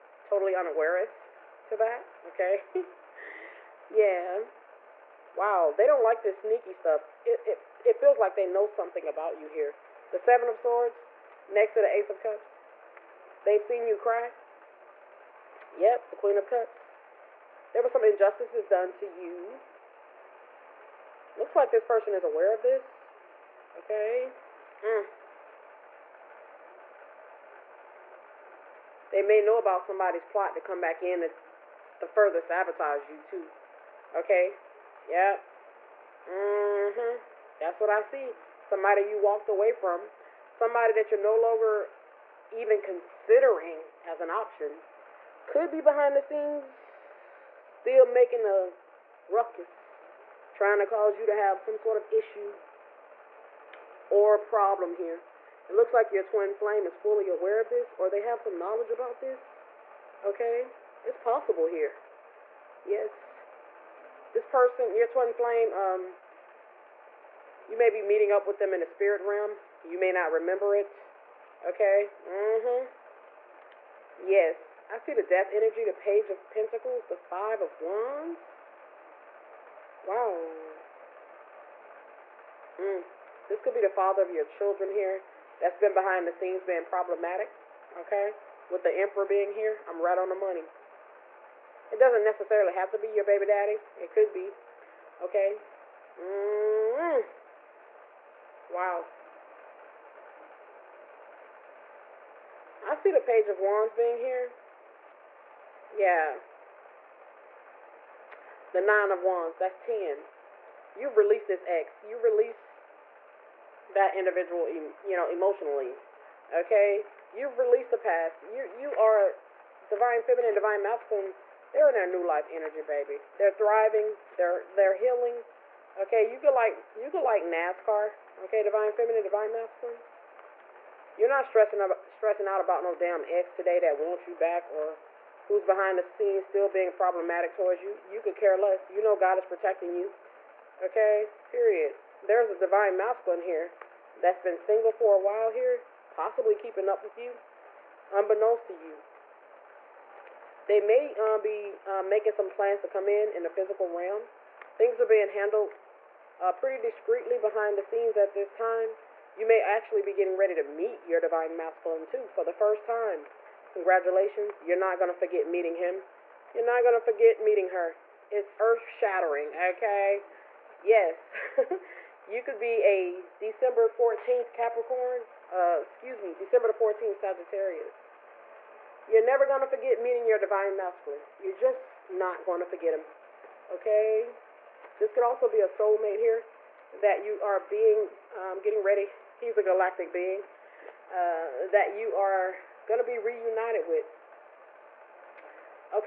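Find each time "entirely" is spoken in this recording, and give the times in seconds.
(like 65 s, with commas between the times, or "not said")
not said.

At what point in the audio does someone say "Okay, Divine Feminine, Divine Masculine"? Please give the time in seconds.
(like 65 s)
128 s.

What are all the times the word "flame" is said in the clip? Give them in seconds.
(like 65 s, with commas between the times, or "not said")
56 s, 65 s.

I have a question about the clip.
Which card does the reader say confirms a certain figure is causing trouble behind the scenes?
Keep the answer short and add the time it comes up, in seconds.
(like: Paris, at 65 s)
The Emperor, at 88 s.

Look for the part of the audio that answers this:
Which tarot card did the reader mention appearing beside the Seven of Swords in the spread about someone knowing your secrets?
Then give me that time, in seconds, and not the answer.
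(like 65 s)
11 s.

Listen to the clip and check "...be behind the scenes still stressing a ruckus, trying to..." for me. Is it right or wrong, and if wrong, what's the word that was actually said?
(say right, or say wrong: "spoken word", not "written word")
wrong: "making", not "stressing".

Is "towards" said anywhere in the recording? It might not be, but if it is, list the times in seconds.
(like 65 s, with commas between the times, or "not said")
137 s.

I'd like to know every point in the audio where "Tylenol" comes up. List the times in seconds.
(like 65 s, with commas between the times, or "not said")
not said.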